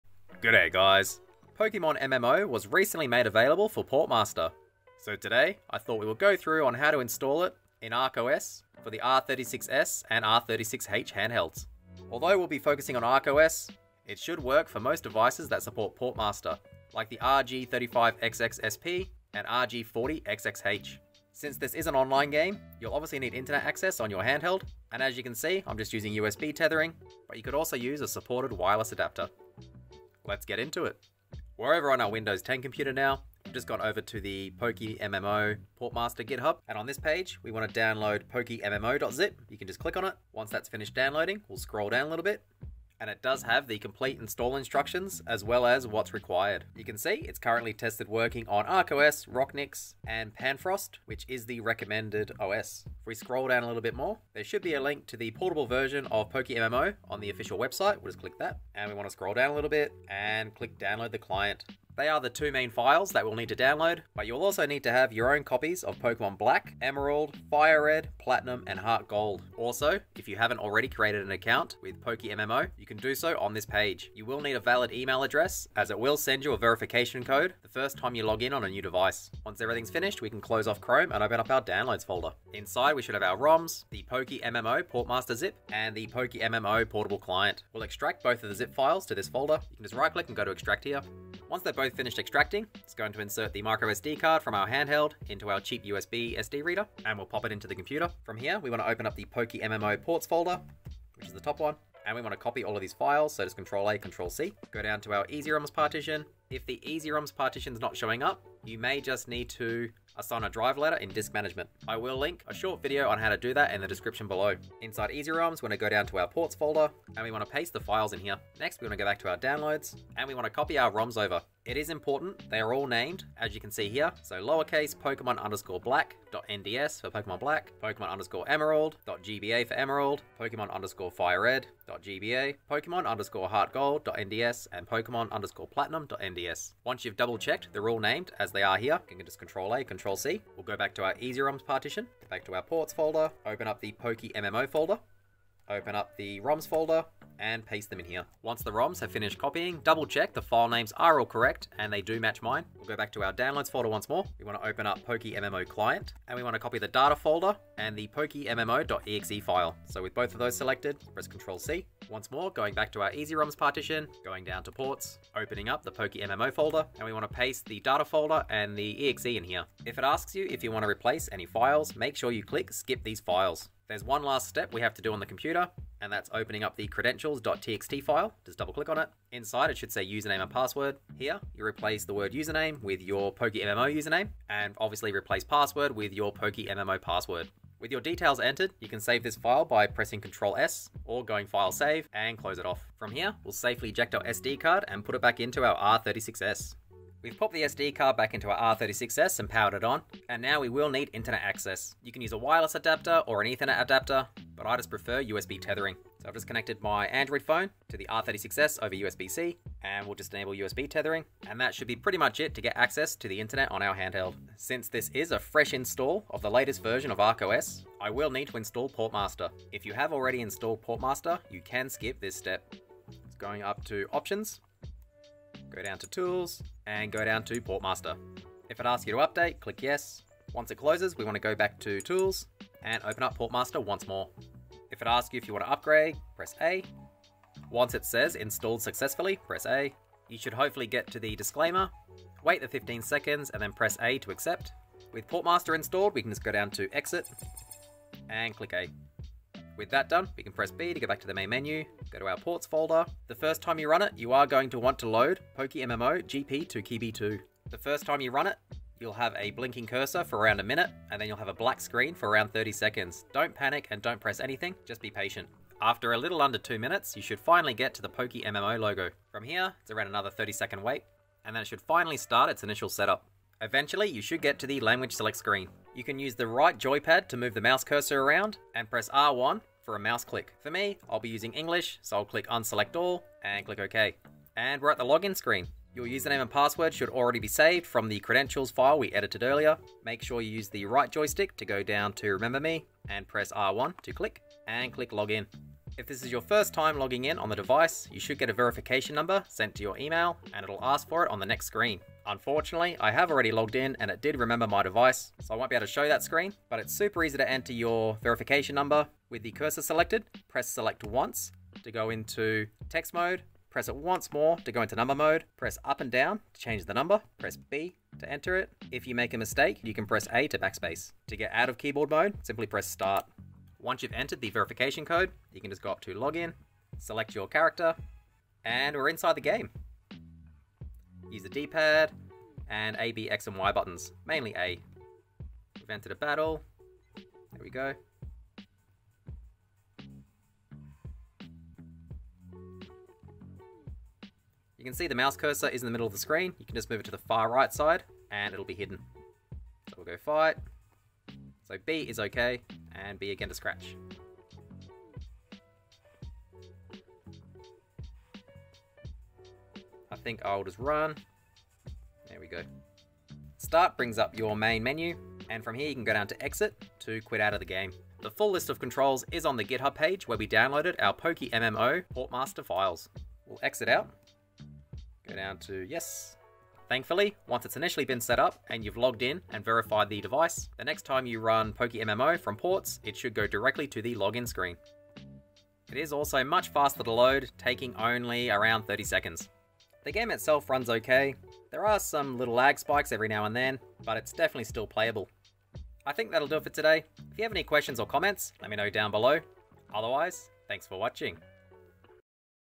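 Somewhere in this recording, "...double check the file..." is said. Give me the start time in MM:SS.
02:29.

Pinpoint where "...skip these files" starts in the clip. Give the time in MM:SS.
02:52.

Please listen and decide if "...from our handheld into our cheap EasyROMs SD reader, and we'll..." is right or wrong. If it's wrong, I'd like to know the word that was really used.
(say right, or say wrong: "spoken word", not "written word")
wrong: "USB", not "EasyROMs".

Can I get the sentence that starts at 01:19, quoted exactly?
Once everything's finished, we can close off Chrome and open up our downloads folder.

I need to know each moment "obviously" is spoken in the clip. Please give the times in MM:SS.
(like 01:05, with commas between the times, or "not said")
00:22, 03:04.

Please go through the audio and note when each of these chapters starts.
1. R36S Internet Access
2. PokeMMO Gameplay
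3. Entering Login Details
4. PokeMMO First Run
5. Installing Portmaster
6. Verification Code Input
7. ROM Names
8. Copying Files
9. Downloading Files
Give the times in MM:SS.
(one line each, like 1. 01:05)
1. 03:17
2. 05:29
3. 02:52
4. 04:09
5. 03:34
6. 04:55
7. 02:00
8. 01:30
9. 00:30.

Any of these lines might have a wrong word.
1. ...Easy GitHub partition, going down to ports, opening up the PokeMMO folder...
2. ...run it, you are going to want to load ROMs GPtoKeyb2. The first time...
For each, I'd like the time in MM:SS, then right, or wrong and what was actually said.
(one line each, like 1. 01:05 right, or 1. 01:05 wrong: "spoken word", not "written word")
1. 02:43 wrong: "ROMs", not "GitHub"
2. 04:13 wrong: "PokeMMO", not "ROMs".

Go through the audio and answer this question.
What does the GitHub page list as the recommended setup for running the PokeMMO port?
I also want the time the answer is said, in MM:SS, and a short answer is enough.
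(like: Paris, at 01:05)
Panfrost, at 00:50.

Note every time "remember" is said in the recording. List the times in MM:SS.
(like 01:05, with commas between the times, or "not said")
04:52, 05:04.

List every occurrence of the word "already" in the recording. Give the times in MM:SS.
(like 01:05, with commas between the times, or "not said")
01:10, 03:40, 04:47, 05:03.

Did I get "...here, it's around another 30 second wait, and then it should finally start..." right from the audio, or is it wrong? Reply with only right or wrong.
right.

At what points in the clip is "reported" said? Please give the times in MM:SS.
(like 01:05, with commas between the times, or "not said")
not said.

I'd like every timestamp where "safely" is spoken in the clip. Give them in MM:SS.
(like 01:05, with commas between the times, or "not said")
03:13.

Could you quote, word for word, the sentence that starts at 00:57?
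We'll just click that, and we want to scroll down a little bit and click download the client.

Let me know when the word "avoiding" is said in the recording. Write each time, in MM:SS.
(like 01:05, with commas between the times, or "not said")
not said.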